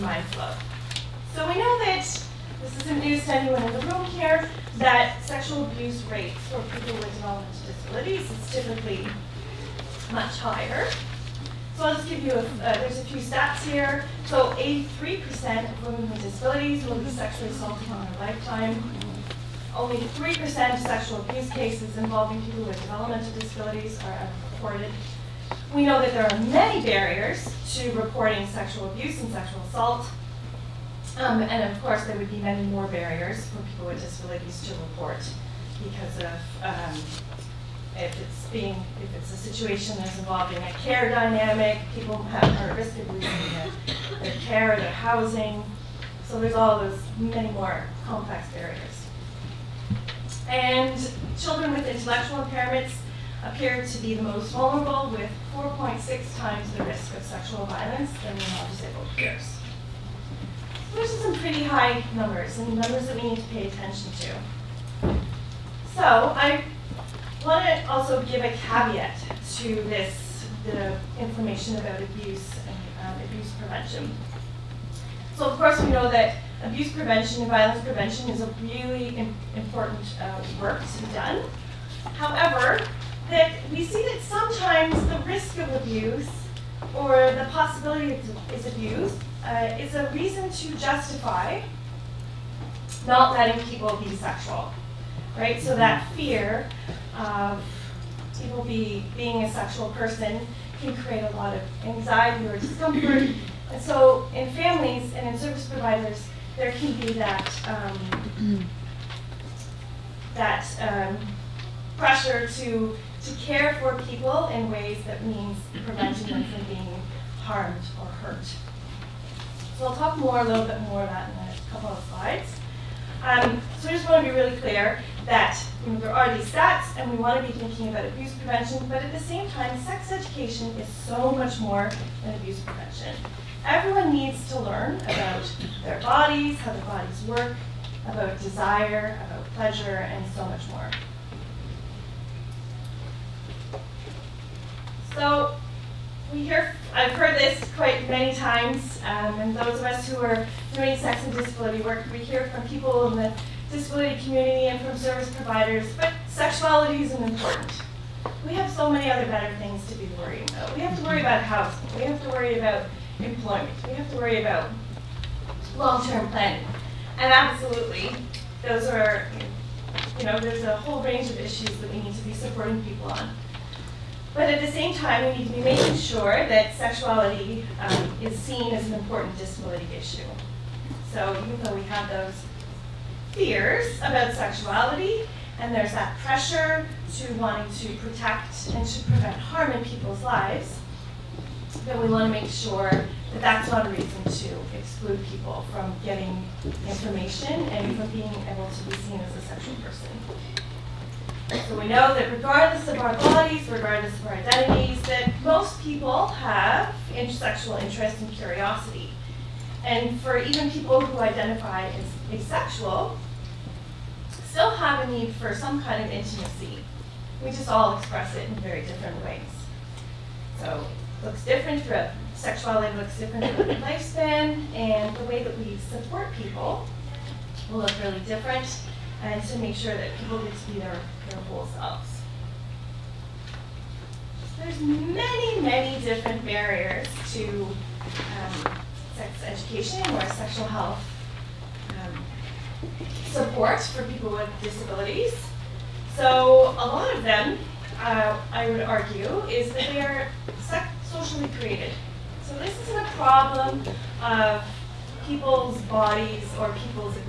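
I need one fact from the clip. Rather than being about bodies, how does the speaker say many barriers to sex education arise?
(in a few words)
socially created.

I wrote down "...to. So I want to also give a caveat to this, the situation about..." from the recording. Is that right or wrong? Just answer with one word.
wrong.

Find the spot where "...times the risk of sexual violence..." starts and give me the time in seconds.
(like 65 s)
56 s.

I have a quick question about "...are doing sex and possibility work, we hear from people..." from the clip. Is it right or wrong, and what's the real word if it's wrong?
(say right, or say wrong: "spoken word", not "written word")
wrong: "disability", not "possibility".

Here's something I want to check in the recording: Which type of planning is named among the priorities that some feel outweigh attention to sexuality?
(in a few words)
long-term planning.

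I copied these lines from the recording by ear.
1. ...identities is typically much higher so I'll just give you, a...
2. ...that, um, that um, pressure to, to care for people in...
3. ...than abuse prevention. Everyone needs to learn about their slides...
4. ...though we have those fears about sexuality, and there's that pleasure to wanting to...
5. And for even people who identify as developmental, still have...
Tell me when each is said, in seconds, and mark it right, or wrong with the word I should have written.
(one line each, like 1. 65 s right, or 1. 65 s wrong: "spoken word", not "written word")
1. 7 s wrong: "disabilities", not "identities"
2. 107 s right
3. 132 s wrong: "bodies", not "slides"
4. 181 s wrong: "pressure", not "pleasure"
5. 209 s wrong: "asexual", not "developmental".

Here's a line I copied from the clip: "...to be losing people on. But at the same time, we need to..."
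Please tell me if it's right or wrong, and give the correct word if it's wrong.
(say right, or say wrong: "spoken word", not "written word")
wrong: "supporting", not "losing".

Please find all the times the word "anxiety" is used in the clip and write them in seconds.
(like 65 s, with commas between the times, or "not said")
101 s.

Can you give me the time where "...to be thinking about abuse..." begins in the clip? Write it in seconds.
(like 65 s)
127 s.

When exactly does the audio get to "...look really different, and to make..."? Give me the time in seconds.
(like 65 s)
227 s.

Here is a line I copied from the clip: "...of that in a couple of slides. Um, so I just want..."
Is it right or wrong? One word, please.
right.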